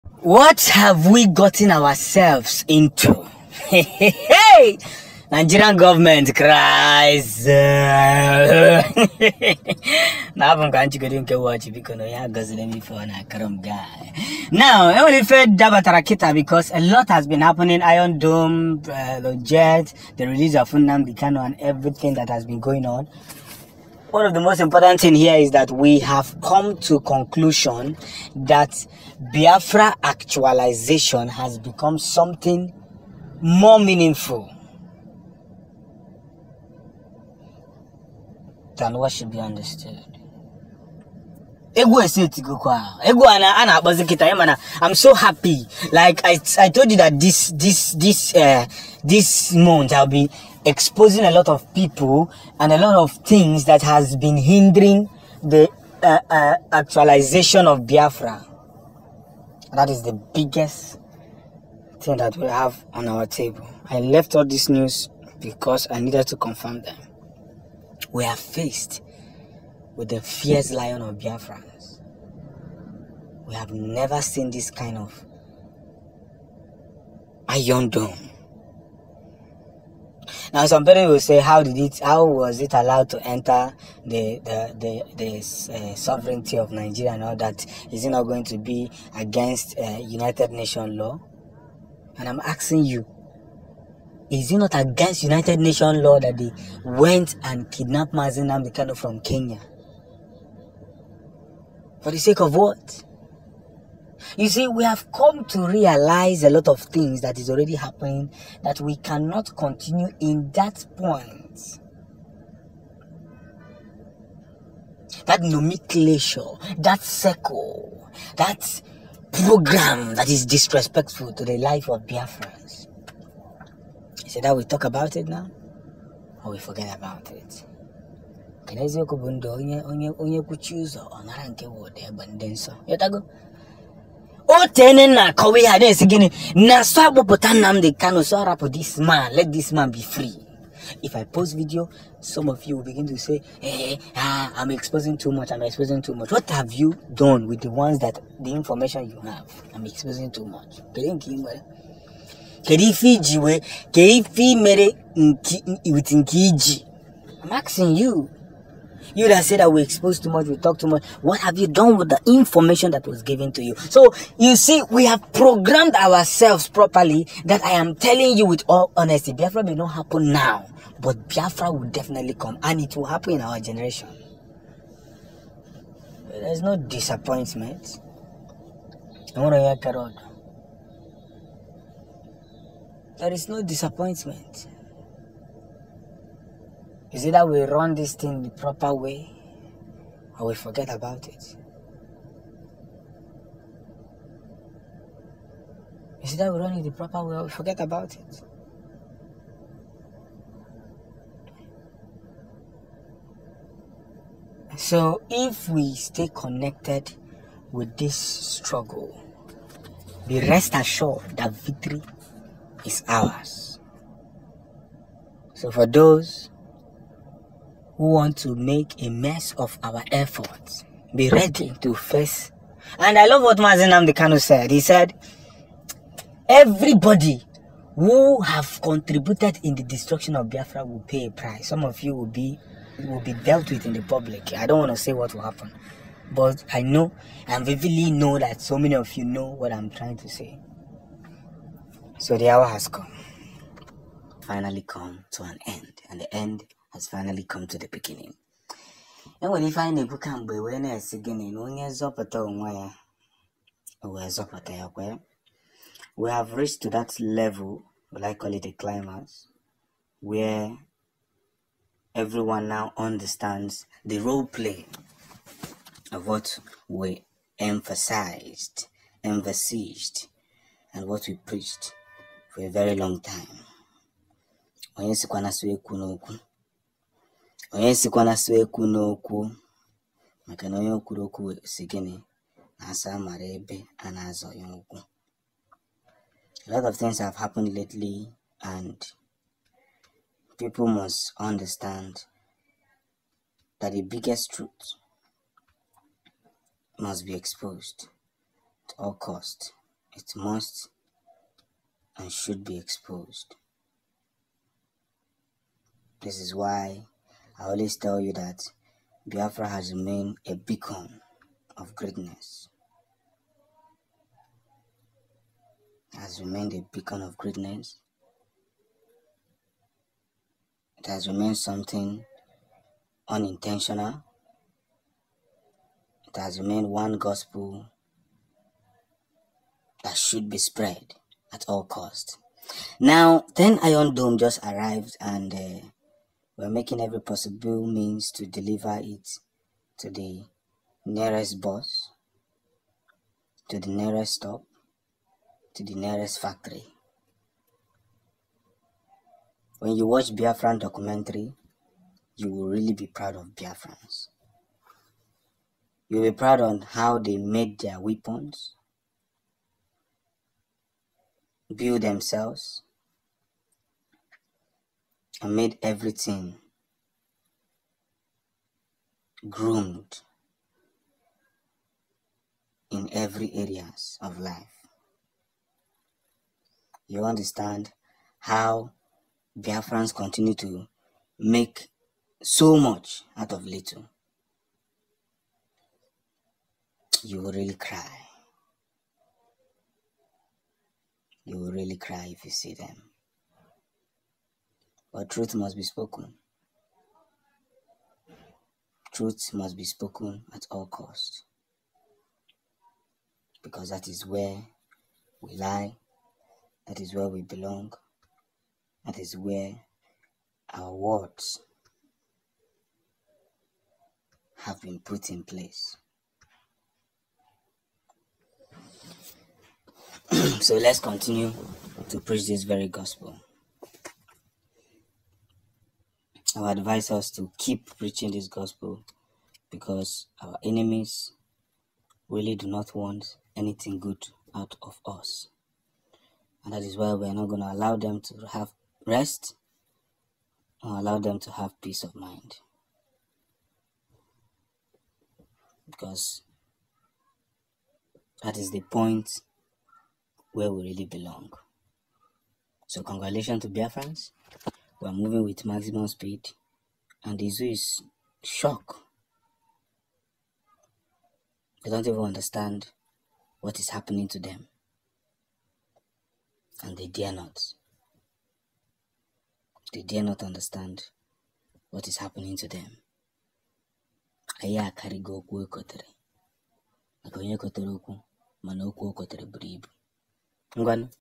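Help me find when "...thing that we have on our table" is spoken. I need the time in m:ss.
1:02.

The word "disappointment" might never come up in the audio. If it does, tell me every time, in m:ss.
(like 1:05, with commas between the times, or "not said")
2:56, 3:03.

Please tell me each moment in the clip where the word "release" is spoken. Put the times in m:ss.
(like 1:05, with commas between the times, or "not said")
0:20.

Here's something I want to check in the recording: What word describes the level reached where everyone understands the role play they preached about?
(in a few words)
climax.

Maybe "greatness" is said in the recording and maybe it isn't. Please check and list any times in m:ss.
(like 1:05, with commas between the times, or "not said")
5:11, 5:17.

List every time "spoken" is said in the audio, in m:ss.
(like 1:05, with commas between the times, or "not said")
6:35, 6:39.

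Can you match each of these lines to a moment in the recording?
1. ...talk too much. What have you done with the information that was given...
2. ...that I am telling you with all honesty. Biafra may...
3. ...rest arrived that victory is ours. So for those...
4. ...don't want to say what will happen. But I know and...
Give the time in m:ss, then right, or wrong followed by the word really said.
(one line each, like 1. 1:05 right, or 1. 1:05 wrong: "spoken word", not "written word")
1. 2:40 right
2. 2:47 right
3. 3:30 wrong: "assured", not "arrived"
4. 3:54 right.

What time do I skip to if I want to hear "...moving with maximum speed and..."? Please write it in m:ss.
7:35.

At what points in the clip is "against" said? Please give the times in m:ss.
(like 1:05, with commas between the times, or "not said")
1:29, 1:34.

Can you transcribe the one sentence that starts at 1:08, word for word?
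We are faced with the fierce lion of Biafrans.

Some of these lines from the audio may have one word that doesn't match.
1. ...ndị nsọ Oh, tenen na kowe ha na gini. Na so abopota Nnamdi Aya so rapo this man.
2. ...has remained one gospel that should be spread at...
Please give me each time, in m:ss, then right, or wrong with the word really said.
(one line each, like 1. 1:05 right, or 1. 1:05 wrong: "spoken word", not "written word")
1. 2:12 wrong: "Kanu", not "Aya"
2. 5:26 right.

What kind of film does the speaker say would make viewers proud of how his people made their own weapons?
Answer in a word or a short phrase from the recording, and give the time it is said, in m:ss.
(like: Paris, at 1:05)
Biafran documentary, at 5:50.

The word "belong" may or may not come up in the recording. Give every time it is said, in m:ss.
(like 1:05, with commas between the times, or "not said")
6:47, 7:31.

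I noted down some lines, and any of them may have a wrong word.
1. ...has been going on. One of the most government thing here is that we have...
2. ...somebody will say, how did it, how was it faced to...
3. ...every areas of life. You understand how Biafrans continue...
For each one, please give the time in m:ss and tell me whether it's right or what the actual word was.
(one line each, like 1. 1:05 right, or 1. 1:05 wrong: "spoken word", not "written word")
1. 0:22 wrong: "important", not "government"
2. 1:20 wrong: "allowed", not "faced"
3. 6:13 right.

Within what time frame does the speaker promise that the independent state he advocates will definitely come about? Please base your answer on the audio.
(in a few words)
our generation.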